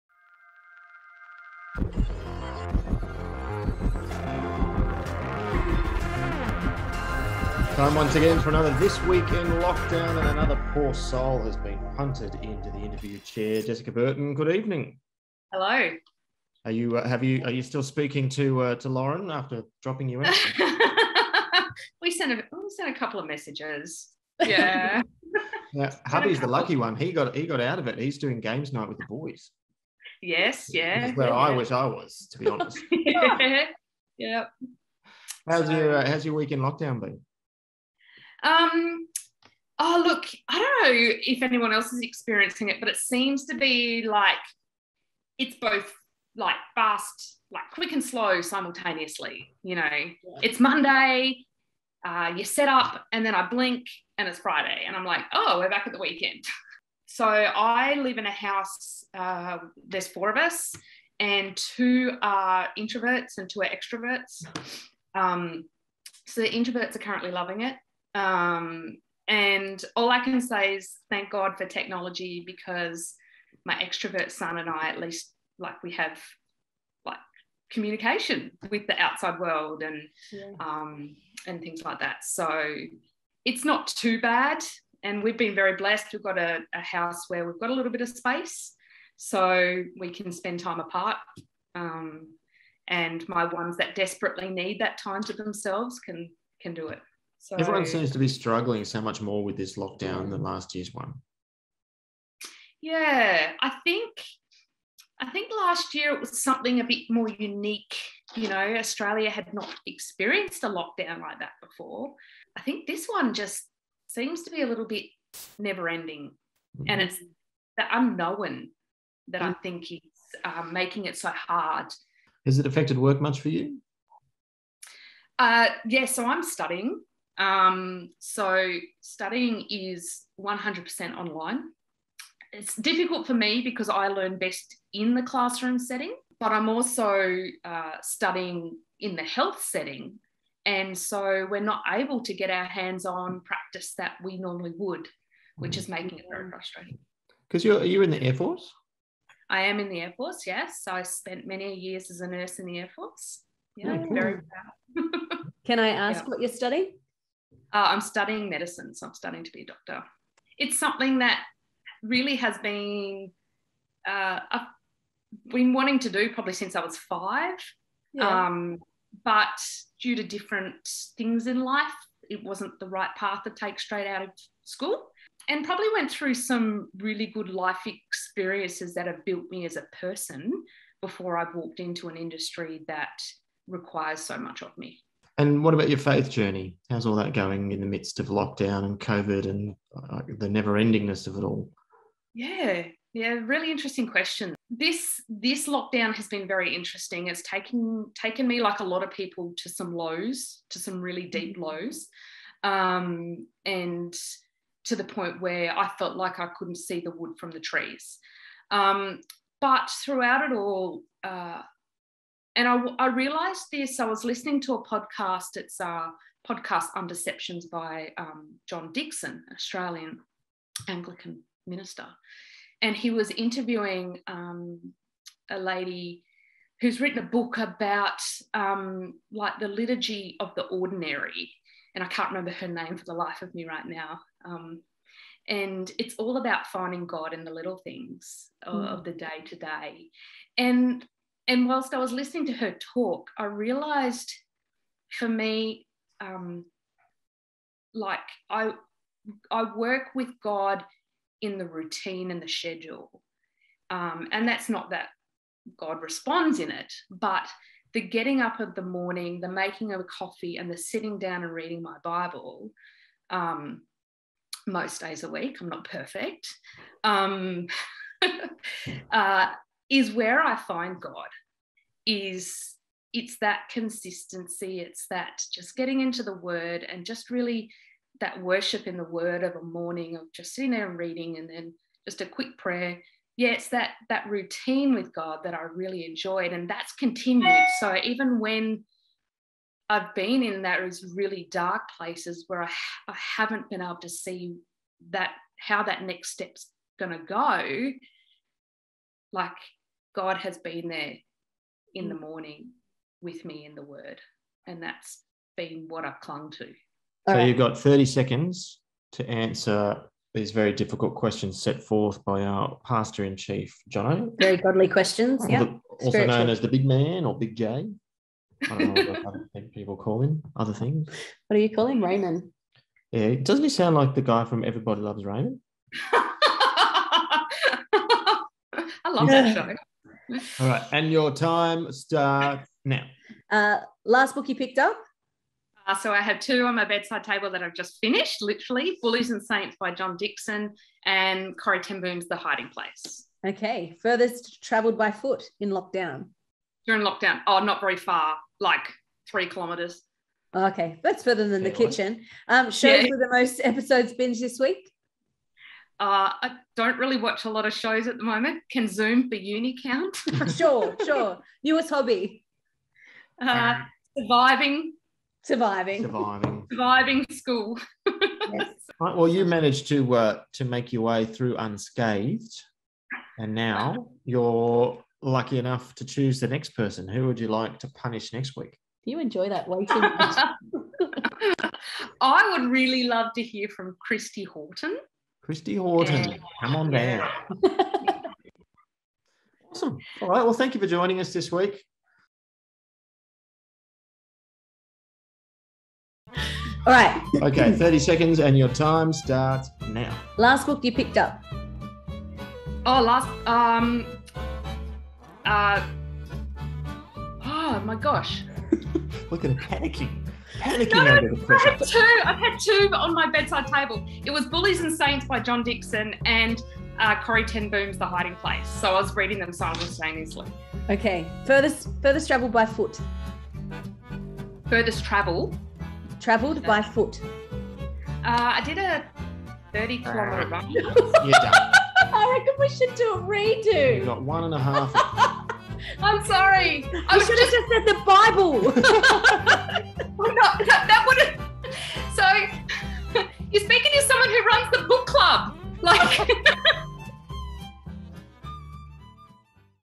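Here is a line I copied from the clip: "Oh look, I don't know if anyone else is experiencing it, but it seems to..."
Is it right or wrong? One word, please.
right.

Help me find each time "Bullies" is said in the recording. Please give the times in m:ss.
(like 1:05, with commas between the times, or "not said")
5:39, 6:54.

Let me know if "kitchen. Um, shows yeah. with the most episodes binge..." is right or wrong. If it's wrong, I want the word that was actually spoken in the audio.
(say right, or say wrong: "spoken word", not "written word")
right.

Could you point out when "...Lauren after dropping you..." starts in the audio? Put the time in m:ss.
0:18.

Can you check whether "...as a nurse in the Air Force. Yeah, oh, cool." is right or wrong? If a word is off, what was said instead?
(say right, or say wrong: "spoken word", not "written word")
right.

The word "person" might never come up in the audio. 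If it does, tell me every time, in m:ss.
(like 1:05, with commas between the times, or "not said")
2:59, 6:16.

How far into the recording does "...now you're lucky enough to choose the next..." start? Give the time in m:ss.
6:13.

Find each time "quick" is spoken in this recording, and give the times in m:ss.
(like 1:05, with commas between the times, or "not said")
0:47, 4:42.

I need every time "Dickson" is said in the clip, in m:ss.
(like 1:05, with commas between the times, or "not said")
3:38, 5:40.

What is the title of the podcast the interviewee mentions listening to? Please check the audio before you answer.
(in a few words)
Deceptions.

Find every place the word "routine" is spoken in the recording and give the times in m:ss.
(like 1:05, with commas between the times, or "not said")
4:11, 4:44.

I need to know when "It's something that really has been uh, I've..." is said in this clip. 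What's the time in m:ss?
2:40.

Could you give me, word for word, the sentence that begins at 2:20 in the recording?
And so we're not able to get our hands on practice that we normally would, which mm.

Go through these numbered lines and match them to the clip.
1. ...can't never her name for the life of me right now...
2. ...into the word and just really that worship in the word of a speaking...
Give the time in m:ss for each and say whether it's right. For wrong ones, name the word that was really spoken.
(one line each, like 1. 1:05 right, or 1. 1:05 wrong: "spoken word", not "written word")
1. 3:52 wrong: "remember", not "never"
2. 4:35 wrong: "morning", not "speaking".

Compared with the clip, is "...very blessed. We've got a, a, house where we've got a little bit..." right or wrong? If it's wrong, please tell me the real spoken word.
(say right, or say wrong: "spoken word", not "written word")
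right.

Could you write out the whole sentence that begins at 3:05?
And what about your faith journey?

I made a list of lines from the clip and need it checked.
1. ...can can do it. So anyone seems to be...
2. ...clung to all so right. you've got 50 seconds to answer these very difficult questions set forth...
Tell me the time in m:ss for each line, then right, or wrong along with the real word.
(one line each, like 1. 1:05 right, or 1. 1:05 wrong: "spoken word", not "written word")
1. 1:35 wrong: "everyone", not "anyone"
2. 5:06 wrong: "30", not "50".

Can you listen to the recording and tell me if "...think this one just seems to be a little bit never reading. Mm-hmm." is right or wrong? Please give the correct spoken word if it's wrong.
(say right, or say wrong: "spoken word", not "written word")
wrong: "ending", not "reading".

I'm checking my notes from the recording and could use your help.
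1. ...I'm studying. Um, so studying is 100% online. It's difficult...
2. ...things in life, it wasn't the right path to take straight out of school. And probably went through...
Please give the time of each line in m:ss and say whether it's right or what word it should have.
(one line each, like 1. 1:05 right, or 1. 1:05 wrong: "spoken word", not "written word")
1. 2:06 right
2. 2:51 right.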